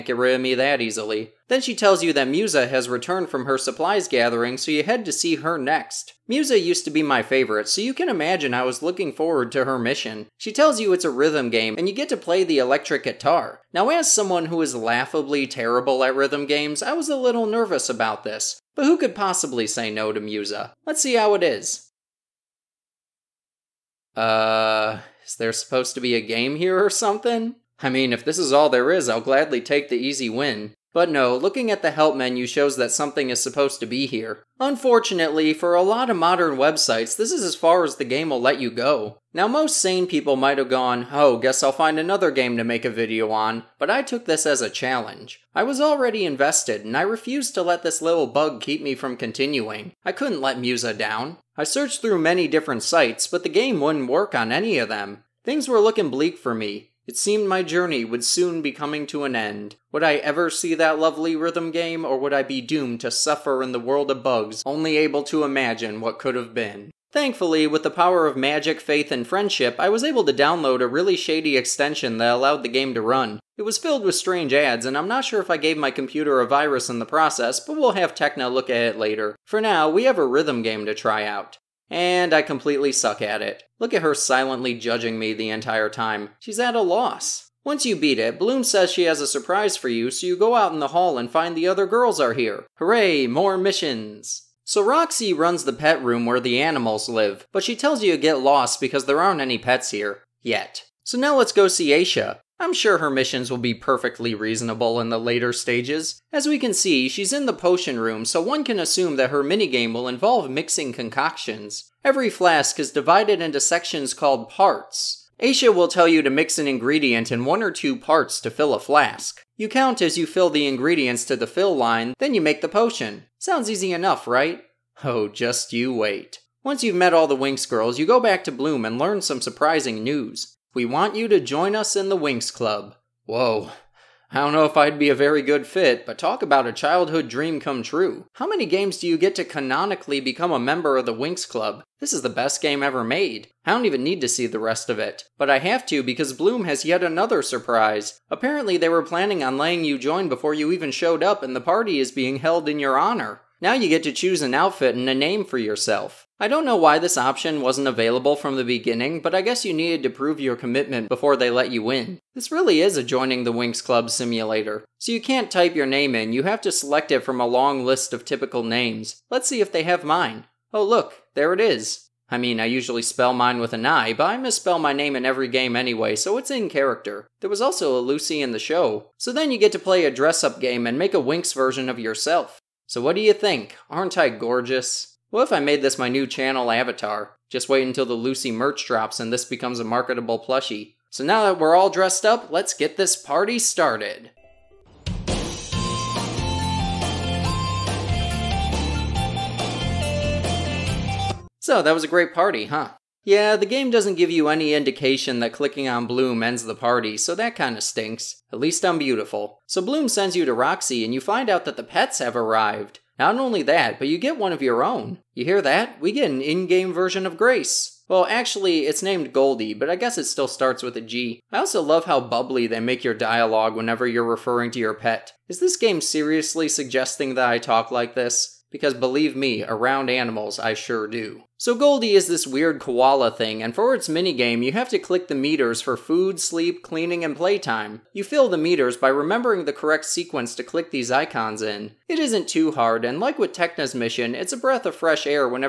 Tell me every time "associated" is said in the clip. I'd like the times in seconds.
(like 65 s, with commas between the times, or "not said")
not said.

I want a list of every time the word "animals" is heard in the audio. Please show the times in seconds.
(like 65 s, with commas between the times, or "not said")
96 s, 230 s.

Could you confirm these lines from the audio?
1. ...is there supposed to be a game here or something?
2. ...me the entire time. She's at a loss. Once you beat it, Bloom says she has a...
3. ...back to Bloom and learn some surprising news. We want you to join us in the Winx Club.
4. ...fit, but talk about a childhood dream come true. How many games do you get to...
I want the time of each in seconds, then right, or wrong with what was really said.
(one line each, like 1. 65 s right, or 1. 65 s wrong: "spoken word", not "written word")
1. 25 s right
2. 85 s right
3. 128 s right
4. 135 s right.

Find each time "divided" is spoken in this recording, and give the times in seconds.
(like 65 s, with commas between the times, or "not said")
112 s.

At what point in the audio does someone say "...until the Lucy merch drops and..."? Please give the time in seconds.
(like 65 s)
187 s.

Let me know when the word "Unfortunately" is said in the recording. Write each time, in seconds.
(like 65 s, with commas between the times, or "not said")
34 s.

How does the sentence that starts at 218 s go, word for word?
Well, actually, it's named Goldie, but I guess it still starts with a G.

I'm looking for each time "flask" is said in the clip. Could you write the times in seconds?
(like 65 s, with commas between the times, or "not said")
112 s, 118 s.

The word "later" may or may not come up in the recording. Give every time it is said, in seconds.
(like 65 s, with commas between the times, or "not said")
78 s, 105 s.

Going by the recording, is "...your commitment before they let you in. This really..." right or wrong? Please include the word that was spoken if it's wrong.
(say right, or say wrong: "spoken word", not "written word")
right.